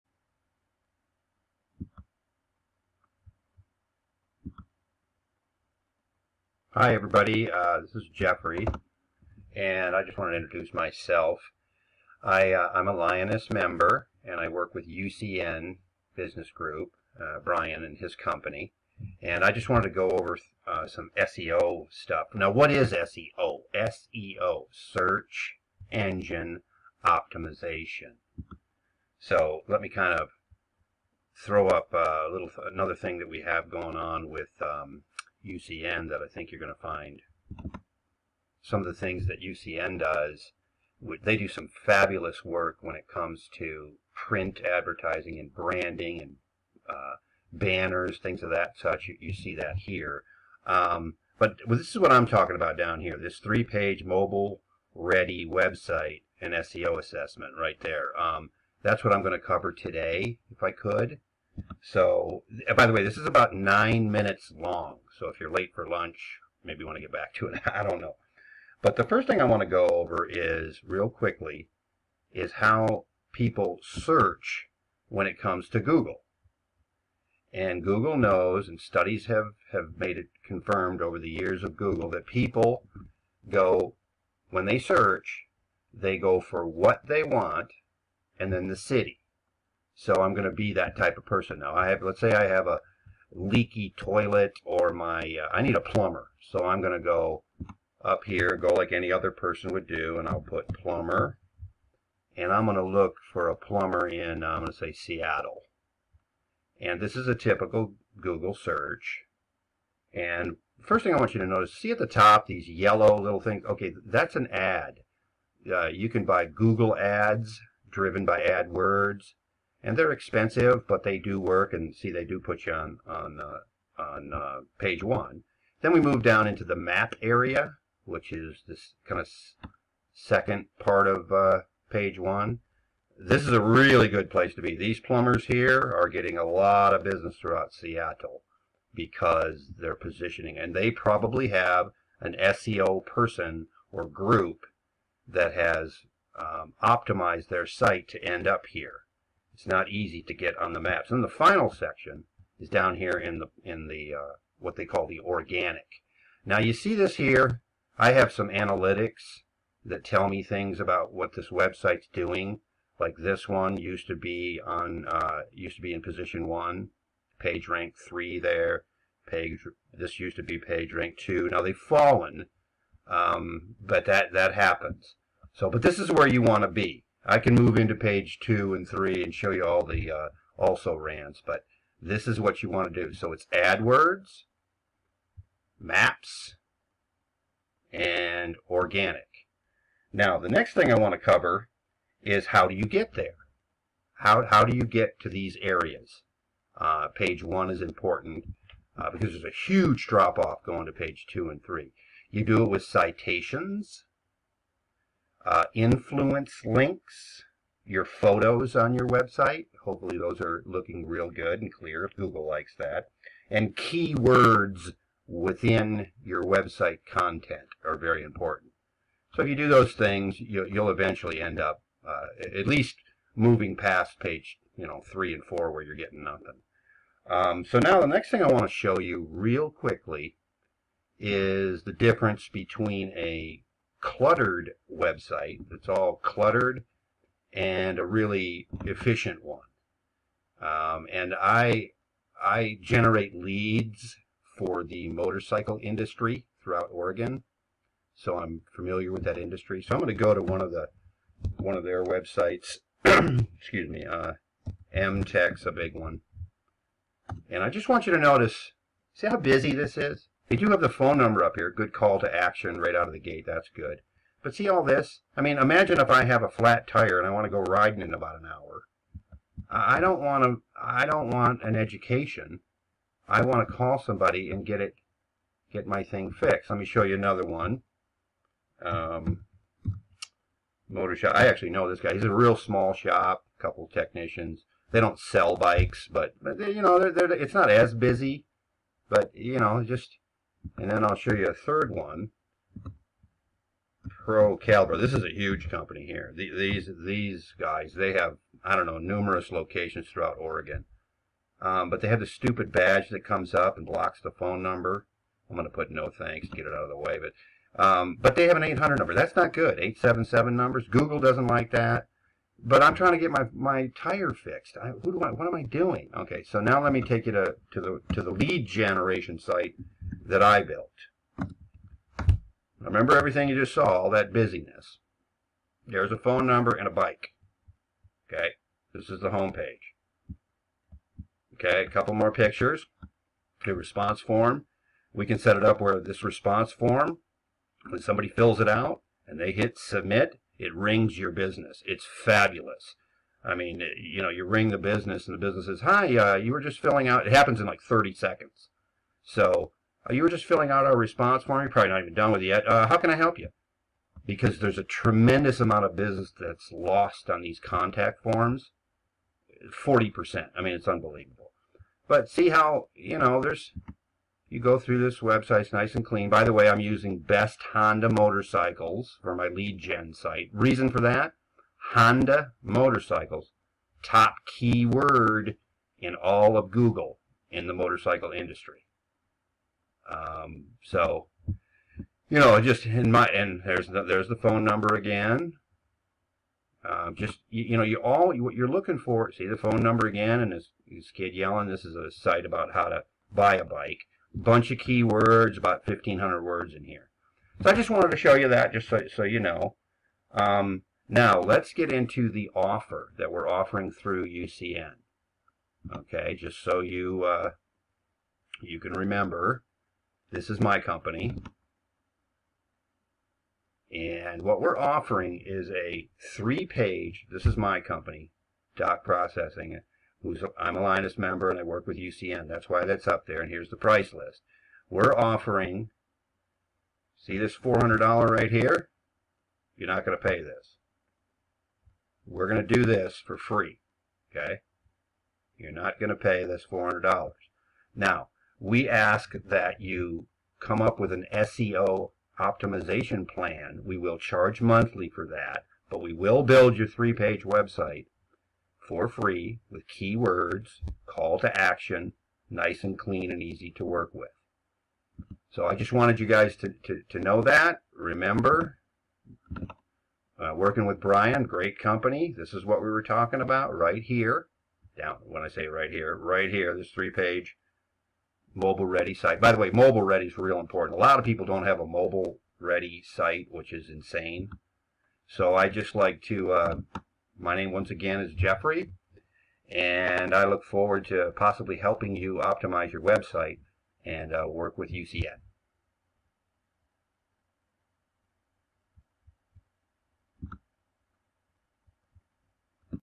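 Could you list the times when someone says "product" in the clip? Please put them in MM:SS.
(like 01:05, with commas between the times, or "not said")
not said.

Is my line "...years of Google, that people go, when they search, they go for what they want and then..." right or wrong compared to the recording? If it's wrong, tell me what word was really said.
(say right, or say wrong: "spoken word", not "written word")
right.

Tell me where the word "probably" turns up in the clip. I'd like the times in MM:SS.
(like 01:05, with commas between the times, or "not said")
02:20, 05:51.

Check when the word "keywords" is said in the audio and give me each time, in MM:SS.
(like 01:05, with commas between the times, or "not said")
03:33, 06:14, 06:34, 07:29.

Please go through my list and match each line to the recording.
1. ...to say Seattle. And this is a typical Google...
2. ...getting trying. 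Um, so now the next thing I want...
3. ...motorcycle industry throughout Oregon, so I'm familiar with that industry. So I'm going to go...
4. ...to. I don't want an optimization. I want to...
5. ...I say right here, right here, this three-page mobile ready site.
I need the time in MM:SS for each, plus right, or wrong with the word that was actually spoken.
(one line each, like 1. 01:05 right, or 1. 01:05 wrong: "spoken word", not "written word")
1. 01:44 right
2. 03:45 wrong: "nothing", not "trying"
3. 04:05 right
4. 04:30 wrong: "education", not "optimization"
5. 07:45 right.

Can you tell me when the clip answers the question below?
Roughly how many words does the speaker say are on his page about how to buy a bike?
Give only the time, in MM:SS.
06:35.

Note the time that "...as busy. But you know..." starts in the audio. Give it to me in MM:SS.
04:47.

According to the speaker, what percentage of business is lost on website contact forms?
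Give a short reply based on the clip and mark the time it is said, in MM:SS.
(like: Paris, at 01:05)
40%, at 05:59.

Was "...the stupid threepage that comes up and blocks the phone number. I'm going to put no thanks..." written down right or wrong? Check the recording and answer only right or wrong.
wrong.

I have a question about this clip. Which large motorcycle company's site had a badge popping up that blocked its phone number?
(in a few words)
Pro Caliber.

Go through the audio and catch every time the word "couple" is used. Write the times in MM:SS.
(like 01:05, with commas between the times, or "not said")
04:43, 05:31.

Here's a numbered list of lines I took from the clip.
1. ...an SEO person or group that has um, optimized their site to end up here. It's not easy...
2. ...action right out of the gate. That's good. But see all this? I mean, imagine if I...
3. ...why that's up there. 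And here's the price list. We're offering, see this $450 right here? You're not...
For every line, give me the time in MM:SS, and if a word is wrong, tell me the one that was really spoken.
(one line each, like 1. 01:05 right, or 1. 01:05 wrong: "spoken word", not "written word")
1. 02:22 right
2. 04:22 right
3. 07:02 wrong: "400", not "450".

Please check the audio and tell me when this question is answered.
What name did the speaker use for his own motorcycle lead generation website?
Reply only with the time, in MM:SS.
06:07.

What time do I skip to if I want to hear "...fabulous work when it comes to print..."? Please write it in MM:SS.
00:41.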